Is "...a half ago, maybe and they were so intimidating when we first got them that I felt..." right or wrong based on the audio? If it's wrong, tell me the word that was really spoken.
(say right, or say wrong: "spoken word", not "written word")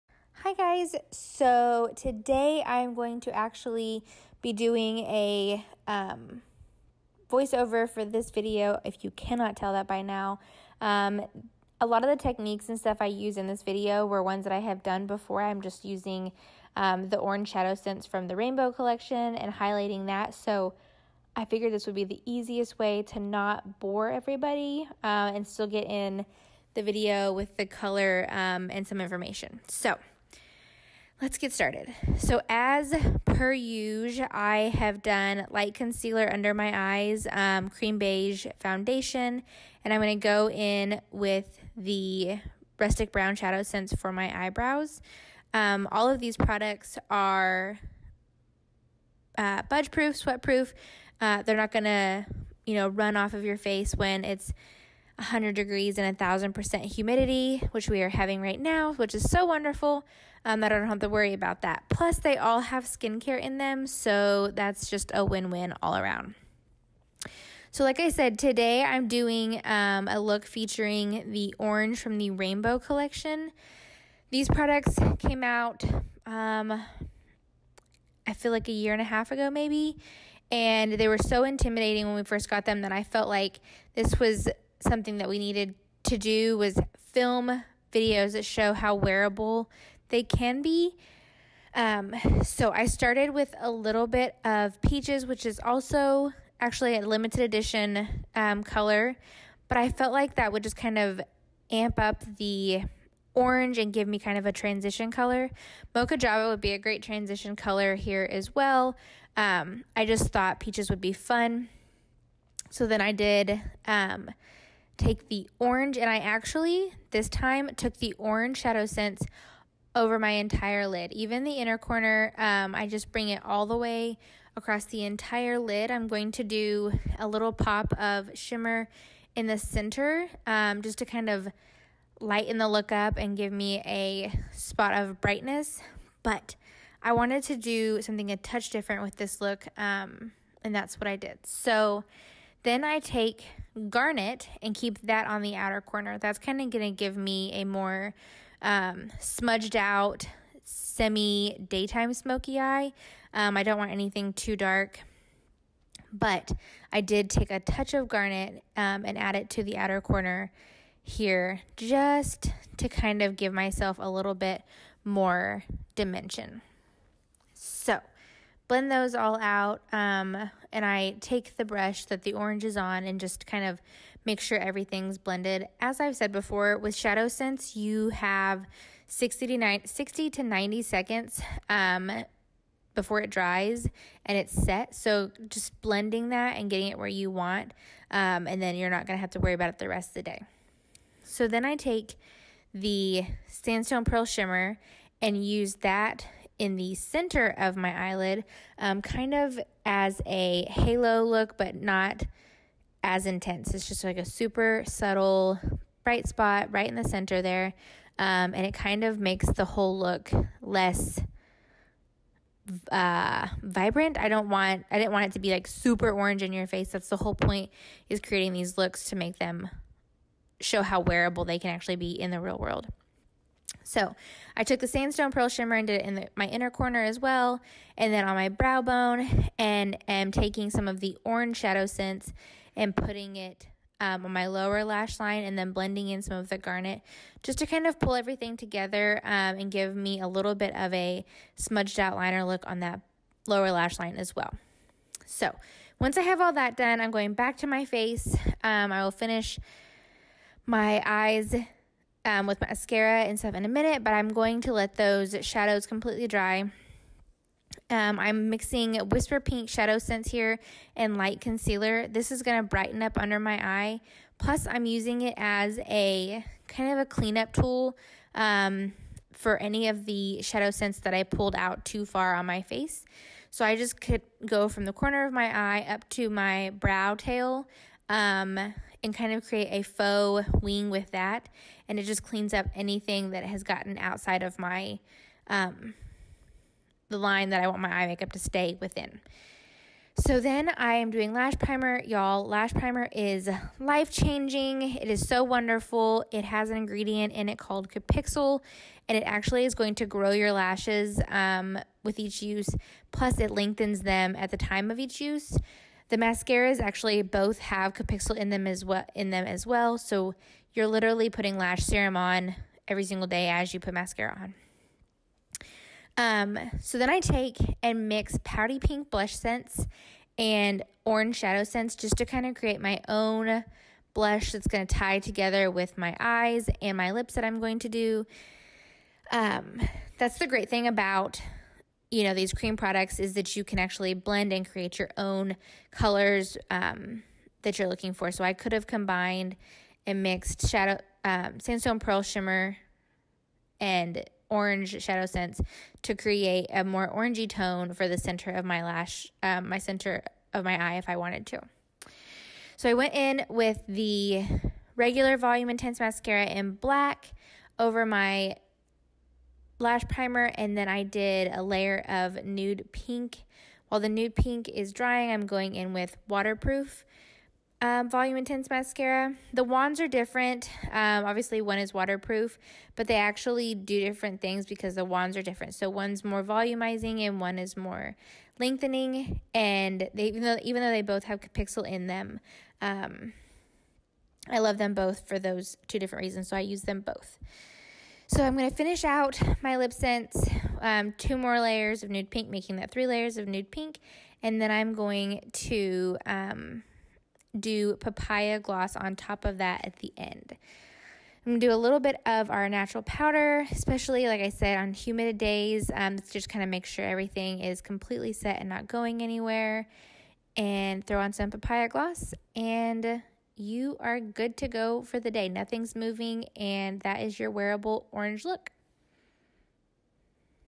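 right.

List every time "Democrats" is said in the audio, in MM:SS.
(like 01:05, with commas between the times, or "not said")
not said.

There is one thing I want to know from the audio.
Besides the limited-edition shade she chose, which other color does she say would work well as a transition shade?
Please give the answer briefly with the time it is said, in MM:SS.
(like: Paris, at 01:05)
Mocha Java, at 01:45.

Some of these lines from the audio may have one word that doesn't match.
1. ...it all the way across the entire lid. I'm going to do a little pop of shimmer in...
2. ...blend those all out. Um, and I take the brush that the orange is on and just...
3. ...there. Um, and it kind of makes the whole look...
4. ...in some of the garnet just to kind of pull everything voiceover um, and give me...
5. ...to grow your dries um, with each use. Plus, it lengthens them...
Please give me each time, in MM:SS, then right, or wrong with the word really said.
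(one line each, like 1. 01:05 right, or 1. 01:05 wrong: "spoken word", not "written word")
1. 02:03 right
2. 02:48 right
3. 03:27 right
4. 03:56 wrong: "together", not "voiceover"
5. 04:59 wrong: "lashes", not "dries".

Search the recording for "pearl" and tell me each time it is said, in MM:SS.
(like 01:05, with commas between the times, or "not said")
03:14, 03:45, 05:41.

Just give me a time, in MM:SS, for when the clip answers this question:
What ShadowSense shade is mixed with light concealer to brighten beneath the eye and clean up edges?
04:19.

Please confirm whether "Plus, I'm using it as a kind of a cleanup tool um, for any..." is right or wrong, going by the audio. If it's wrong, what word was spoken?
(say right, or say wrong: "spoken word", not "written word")
right.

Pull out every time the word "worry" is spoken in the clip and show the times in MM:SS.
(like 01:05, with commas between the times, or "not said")
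01:01, 03:09.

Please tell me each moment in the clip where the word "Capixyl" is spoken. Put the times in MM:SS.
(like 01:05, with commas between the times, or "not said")
04:57, 05:07.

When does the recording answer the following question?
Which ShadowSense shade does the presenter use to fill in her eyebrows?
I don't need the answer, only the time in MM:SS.
00:42.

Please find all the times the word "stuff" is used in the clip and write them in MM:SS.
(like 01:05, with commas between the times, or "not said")
00:12, 04:13.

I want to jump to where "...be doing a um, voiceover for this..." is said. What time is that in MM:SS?
00:04.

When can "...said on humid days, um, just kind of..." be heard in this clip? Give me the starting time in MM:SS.
06:44.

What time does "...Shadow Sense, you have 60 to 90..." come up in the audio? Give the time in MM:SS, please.
02:56.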